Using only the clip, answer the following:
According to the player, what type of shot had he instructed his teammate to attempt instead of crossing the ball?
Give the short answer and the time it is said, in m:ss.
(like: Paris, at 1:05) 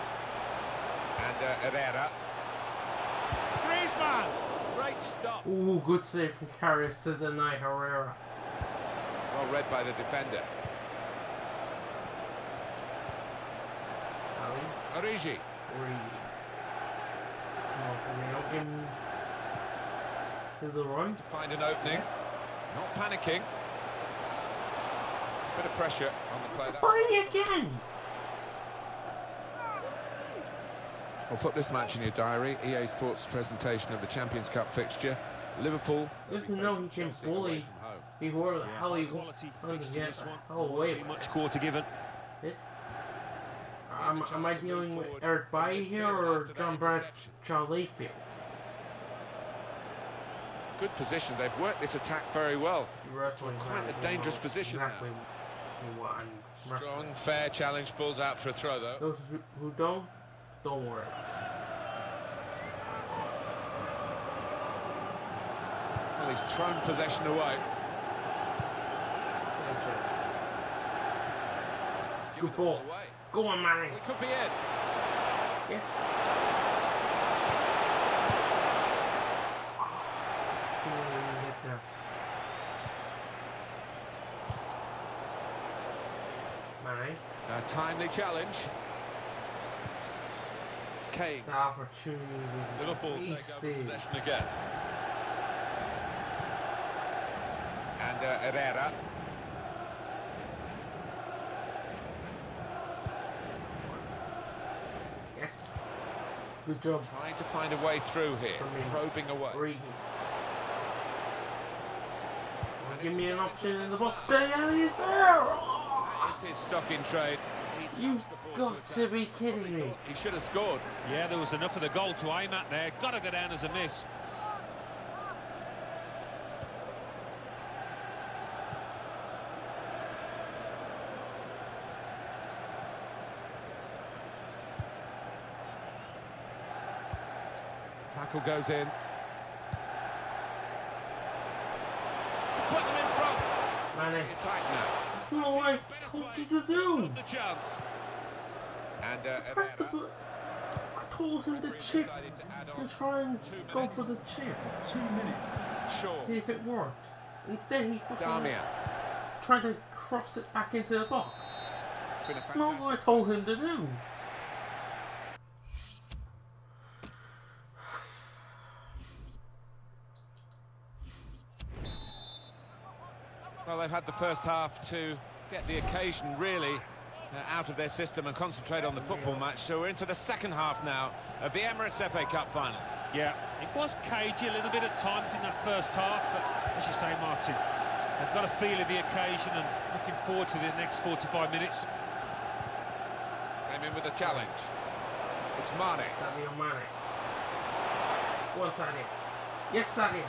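The chip, at 2:34.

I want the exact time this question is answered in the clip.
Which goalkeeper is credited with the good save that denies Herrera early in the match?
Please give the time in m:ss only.
0:06.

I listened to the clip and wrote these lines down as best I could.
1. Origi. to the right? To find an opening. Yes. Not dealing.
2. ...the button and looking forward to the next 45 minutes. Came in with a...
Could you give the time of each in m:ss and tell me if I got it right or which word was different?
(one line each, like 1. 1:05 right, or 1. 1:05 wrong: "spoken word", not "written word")
1. 0:15 wrong: "panicking", not "dealing"
2. 3:08 wrong: "occasion", not "button".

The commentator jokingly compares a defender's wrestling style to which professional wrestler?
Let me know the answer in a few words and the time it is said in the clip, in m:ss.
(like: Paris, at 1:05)
John Bradshaw Layfield, at 0:46.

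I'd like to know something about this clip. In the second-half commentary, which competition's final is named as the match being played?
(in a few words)
Emirates FA Cup.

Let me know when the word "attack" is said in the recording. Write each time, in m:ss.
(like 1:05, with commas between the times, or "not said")
0:51.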